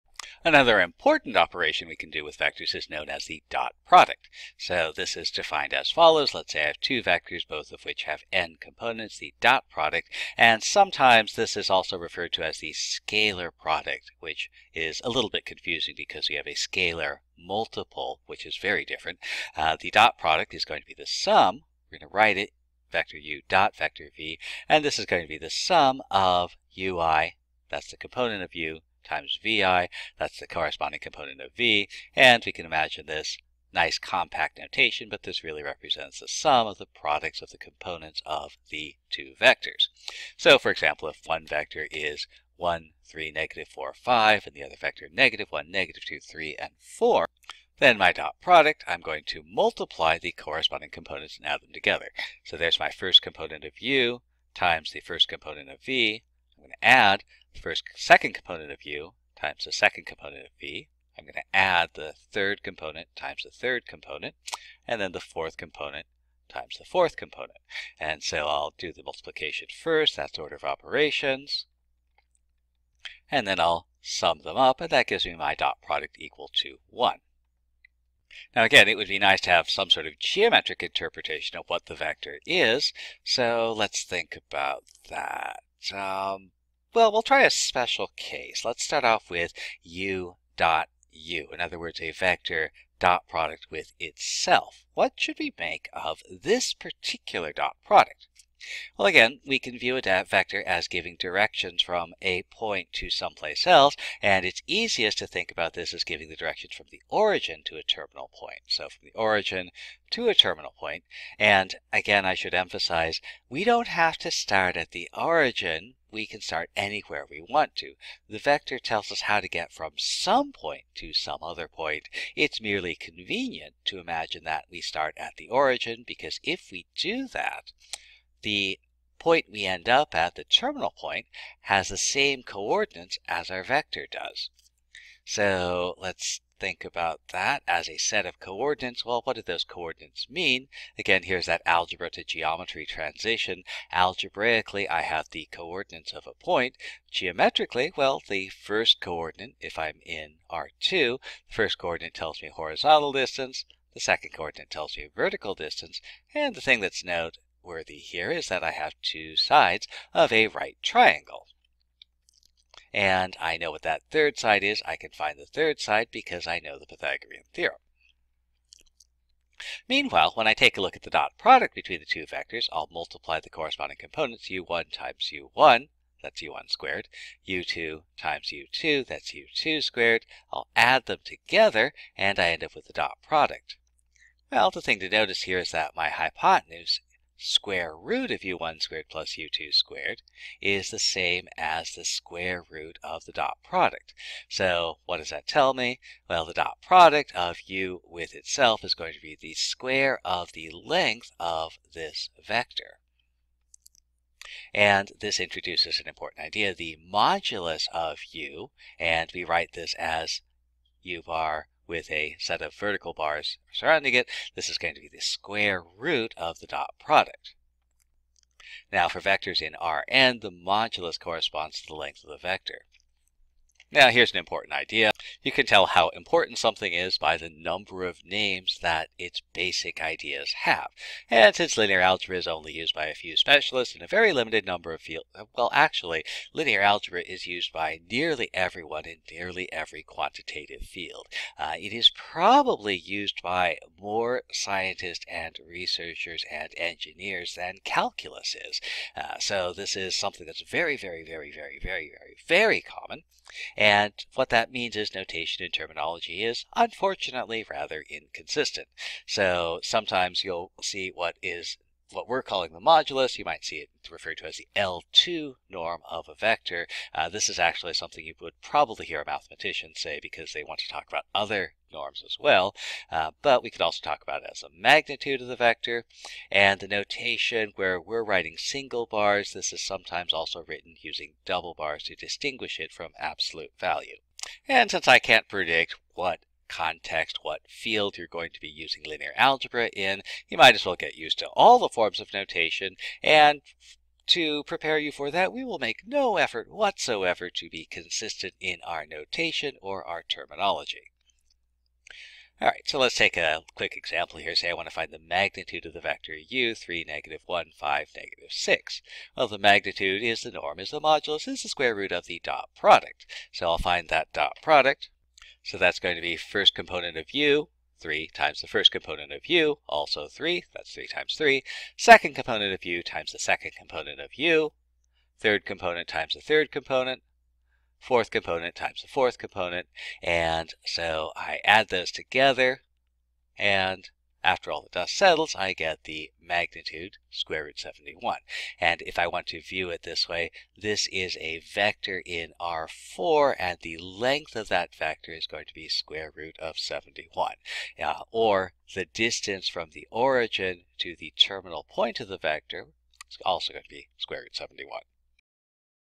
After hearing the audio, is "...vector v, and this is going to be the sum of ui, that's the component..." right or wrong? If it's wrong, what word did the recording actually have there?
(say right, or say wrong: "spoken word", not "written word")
right.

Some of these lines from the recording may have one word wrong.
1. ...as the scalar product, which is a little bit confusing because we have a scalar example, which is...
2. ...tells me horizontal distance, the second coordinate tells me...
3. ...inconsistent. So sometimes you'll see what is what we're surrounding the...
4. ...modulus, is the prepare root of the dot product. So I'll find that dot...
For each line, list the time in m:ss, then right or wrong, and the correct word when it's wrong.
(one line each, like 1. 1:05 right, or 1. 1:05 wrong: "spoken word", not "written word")
1. 0:12 wrong: "multiple", not "example"
2. 2:32 right
3. 4:18 wrong: "calling", not "surrounding"
4. 5:11 wrong: "square", not "prepare".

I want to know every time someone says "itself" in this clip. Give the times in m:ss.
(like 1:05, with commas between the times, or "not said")
1:33, 3:18.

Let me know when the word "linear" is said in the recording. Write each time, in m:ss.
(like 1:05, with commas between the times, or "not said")
3:51, 3:56, 4:49.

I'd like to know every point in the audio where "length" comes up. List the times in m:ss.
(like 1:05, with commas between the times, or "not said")
3:20, 3:41, 5:43.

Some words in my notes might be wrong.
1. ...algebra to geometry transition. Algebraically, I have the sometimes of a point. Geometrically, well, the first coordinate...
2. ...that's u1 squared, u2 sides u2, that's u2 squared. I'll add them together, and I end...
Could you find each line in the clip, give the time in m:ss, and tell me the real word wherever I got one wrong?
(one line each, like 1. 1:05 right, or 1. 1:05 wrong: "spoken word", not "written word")
1. 2:21 wrong: "coordinates", not "sometimes"
2. 2:56 wrong: "times", not "sides".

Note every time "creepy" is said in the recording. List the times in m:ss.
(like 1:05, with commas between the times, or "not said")
not said.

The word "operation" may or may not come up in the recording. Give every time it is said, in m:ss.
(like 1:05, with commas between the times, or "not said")
0:01, 1:10.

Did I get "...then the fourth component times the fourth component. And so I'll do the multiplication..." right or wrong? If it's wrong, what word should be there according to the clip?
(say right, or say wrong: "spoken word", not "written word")
right.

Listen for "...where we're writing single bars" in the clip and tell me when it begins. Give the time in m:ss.
4:37.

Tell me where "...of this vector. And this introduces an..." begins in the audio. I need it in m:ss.
3:21.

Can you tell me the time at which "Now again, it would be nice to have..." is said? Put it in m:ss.
1:18.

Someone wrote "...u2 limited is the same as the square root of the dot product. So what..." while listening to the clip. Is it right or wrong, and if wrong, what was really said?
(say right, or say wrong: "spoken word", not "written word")
wrong: "squared", not "limited".